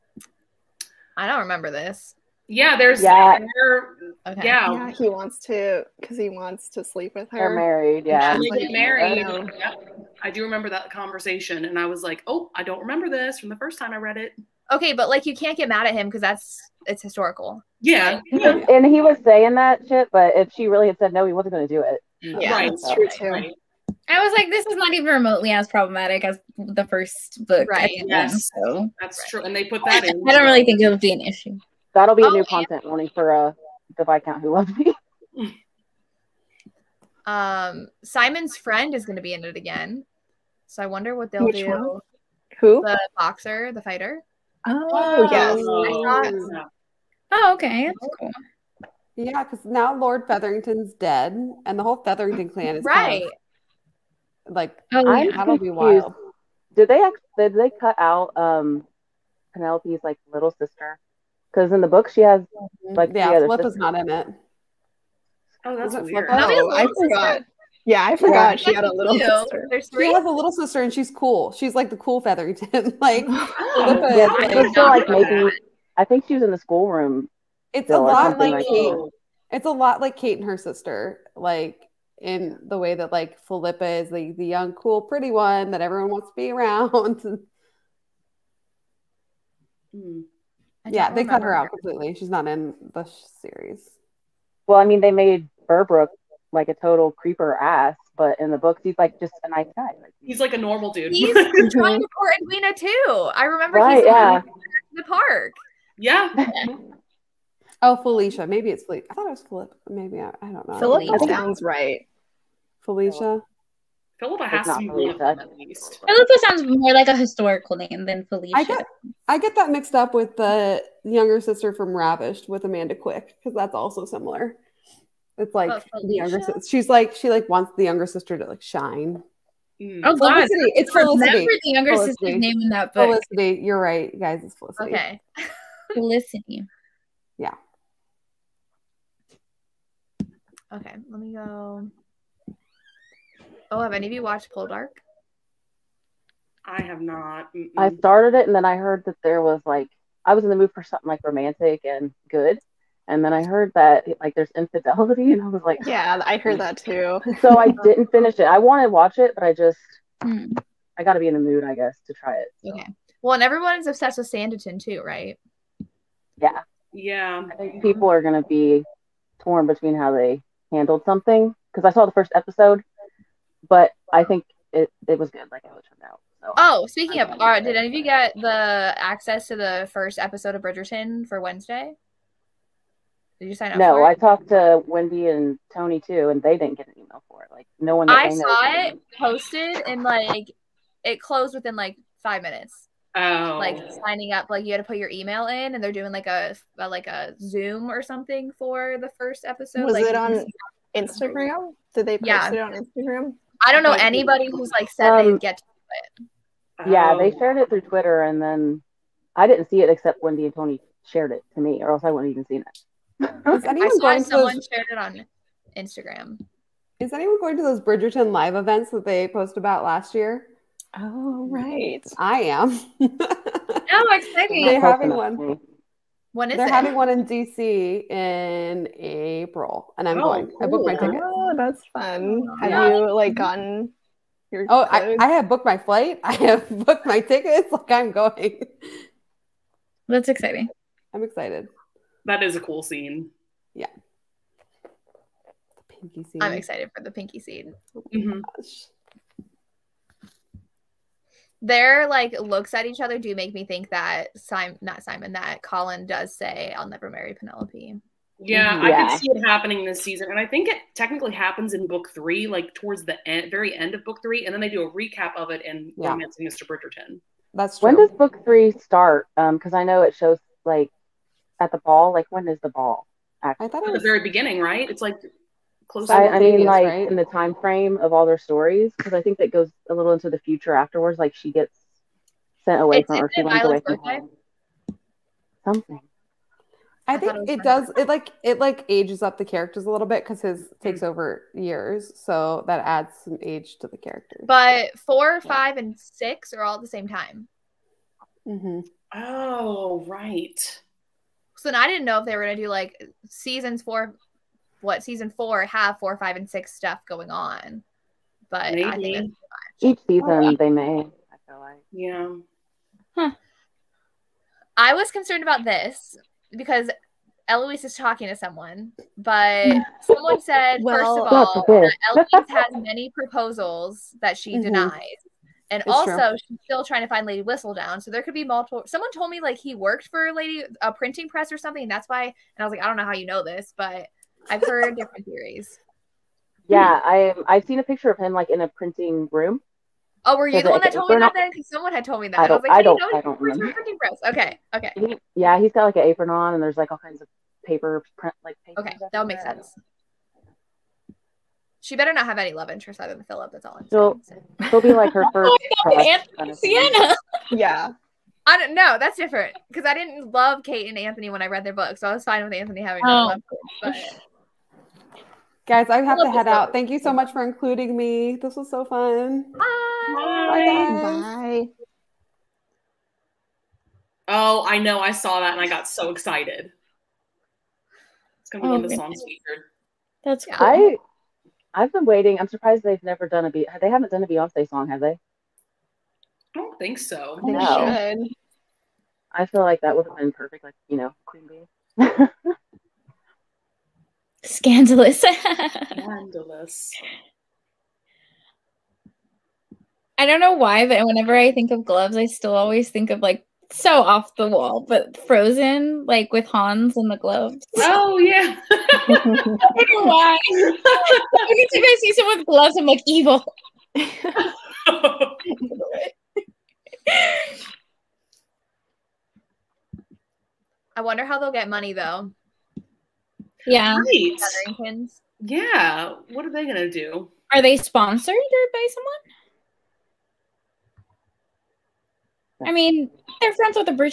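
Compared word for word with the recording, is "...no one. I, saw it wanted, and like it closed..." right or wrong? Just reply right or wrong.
wrong.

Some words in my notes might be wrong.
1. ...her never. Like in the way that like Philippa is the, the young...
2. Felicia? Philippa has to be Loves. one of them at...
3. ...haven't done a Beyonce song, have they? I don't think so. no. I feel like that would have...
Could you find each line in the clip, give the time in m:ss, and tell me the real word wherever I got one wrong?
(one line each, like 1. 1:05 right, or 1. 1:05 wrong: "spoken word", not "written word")
1. 1:20 wrong: "sister", not "never"
2. 1:52 wrong: "Philippa", not "Loves"
3. 6:23 right.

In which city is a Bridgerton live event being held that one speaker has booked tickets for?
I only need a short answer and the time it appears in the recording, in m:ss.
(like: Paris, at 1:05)
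DC, at 3:47.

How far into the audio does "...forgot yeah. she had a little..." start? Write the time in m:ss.
1:08.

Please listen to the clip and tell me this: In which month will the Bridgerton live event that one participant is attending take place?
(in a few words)
April.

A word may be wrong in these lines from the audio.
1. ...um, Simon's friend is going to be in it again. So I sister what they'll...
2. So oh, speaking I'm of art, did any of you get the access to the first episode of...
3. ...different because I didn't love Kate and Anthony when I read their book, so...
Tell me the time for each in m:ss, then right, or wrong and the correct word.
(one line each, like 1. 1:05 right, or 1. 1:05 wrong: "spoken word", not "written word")
1. 0:37 wrong: "wonder", not "sister"
2. 2:56 right
3. 5:59 right.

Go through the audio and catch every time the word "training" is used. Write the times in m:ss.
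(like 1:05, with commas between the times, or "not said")
not said.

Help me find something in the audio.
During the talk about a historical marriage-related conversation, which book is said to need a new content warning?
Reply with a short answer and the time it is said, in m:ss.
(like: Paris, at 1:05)
The Viscount Who Loves Me, at 0:33.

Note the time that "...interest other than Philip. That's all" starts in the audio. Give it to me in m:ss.
5:52.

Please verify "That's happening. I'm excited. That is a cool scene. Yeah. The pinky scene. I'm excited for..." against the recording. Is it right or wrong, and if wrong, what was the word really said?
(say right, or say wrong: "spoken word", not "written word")
wrong: "exciting", not "happening".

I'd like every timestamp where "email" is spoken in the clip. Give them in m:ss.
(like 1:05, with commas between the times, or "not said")
3:06, 3:15.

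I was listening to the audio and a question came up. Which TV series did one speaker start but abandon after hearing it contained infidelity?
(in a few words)
Poldark.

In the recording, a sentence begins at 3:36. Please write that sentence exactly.
Is anyone going to those Bridgerton live events that they posted about last year?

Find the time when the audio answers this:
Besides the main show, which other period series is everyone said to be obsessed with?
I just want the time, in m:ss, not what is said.
2:44.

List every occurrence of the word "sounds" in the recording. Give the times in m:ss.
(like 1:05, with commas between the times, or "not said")
1:51, 1:56.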